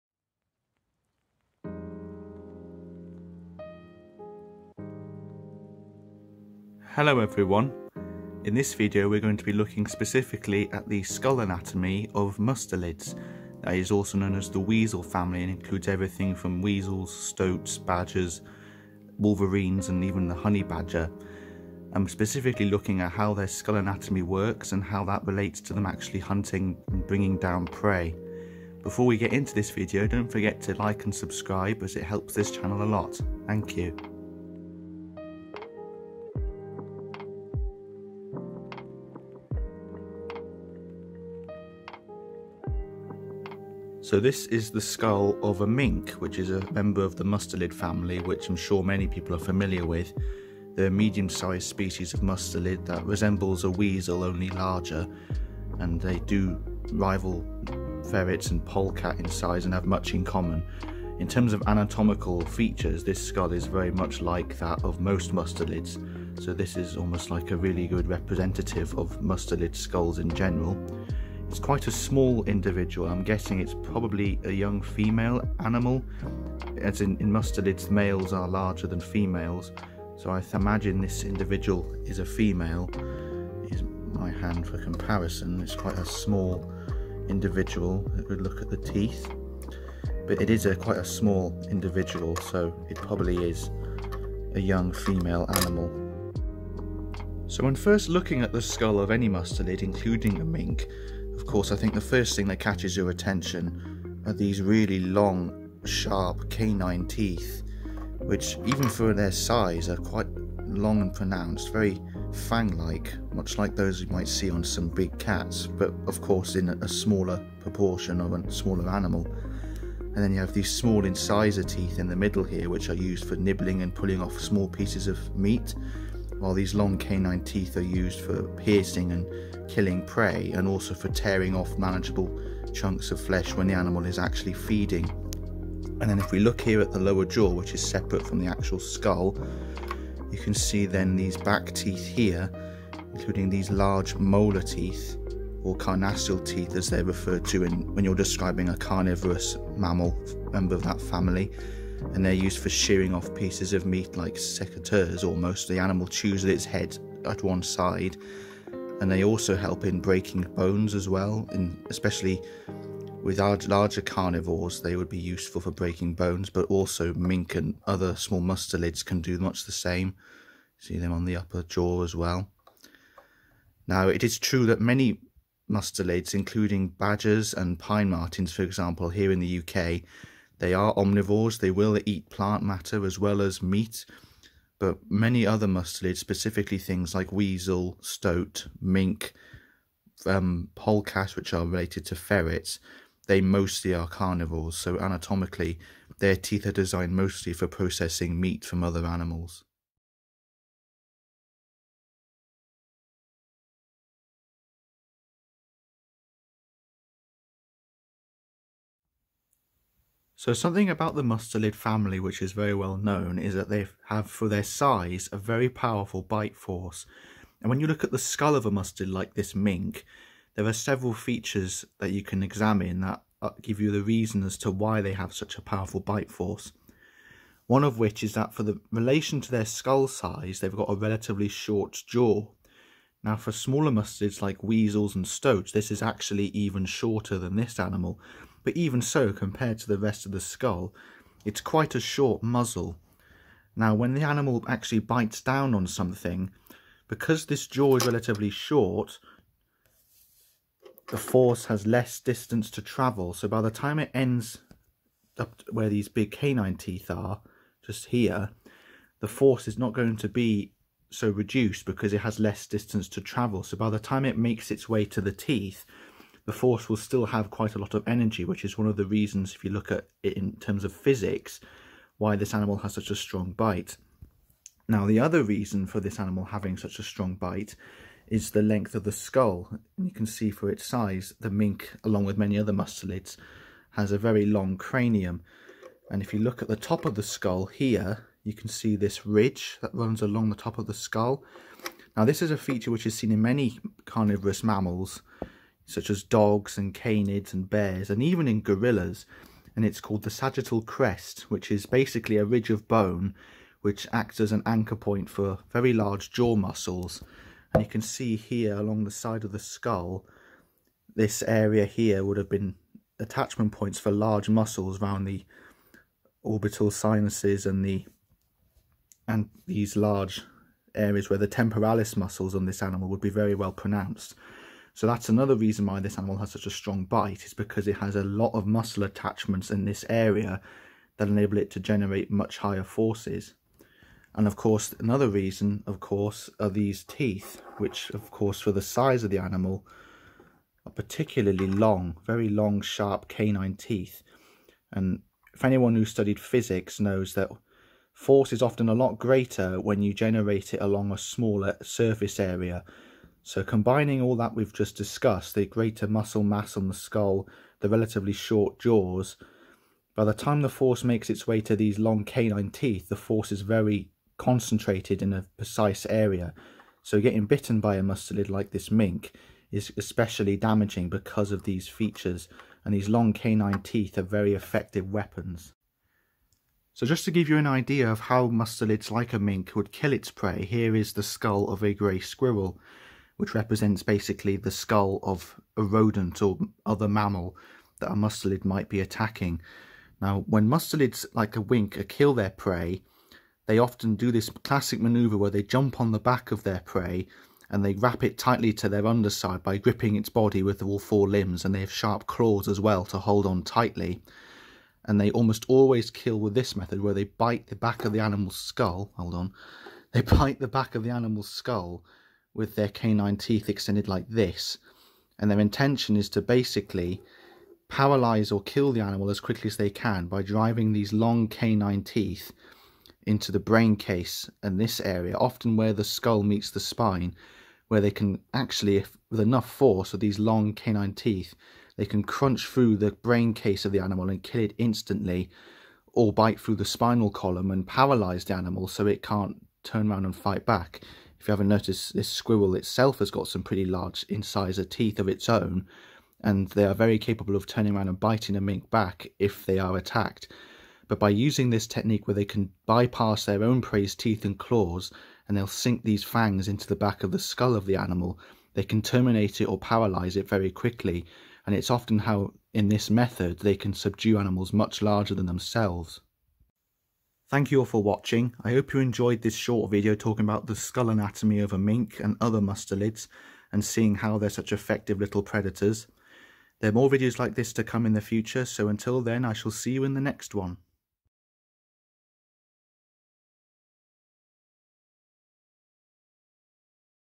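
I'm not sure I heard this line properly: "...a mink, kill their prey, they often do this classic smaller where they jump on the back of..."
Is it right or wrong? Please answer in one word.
wrong.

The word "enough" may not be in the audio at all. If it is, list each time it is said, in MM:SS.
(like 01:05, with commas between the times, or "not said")
07:09.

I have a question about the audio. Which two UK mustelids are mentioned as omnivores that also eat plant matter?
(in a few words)
Badgers and pine martens.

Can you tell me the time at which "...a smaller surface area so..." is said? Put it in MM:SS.
05:51.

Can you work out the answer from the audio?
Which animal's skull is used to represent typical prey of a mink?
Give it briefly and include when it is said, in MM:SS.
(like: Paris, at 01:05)
Grey squirrel, at 06:21.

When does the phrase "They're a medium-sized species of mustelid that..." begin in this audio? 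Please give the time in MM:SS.
00:50.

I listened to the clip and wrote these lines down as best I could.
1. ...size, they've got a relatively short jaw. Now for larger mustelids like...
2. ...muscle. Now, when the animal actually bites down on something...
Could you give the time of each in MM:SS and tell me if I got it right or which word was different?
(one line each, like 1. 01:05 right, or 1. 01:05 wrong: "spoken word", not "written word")
1. 03:50 wrong: "smaller", not "larger"
2. 04:02 wrong: "muzzle", not "muscle".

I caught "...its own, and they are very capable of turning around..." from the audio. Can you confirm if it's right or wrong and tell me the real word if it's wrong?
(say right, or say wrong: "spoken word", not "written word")
right.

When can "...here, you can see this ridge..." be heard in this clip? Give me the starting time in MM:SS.
04:47.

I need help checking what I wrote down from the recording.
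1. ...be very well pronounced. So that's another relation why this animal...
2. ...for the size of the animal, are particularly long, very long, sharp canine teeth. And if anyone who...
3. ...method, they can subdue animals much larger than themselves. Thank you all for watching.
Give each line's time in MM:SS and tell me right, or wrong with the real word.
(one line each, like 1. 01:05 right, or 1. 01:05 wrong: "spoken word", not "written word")
1. 05:23 wrong: "reason", not "relation"
2. 05:38 right
3. 07:43 right.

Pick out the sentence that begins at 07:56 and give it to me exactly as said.
There are more videos like this to come in the future, so until then I shall see you in the next one.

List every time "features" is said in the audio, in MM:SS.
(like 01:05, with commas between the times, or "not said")
01:02, 03:41, 04:52, 06:11.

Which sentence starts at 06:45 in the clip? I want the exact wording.
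And they almost always kill with this method where they bite the back of the animal's skull.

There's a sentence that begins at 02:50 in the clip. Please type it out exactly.
See them on the upper jaw as well.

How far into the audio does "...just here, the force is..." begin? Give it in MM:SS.
04:17.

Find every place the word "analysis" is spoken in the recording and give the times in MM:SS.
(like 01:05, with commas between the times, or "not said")
not said.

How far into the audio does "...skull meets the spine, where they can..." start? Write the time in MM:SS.
07:06.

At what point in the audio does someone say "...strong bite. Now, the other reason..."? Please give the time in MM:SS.
04:33.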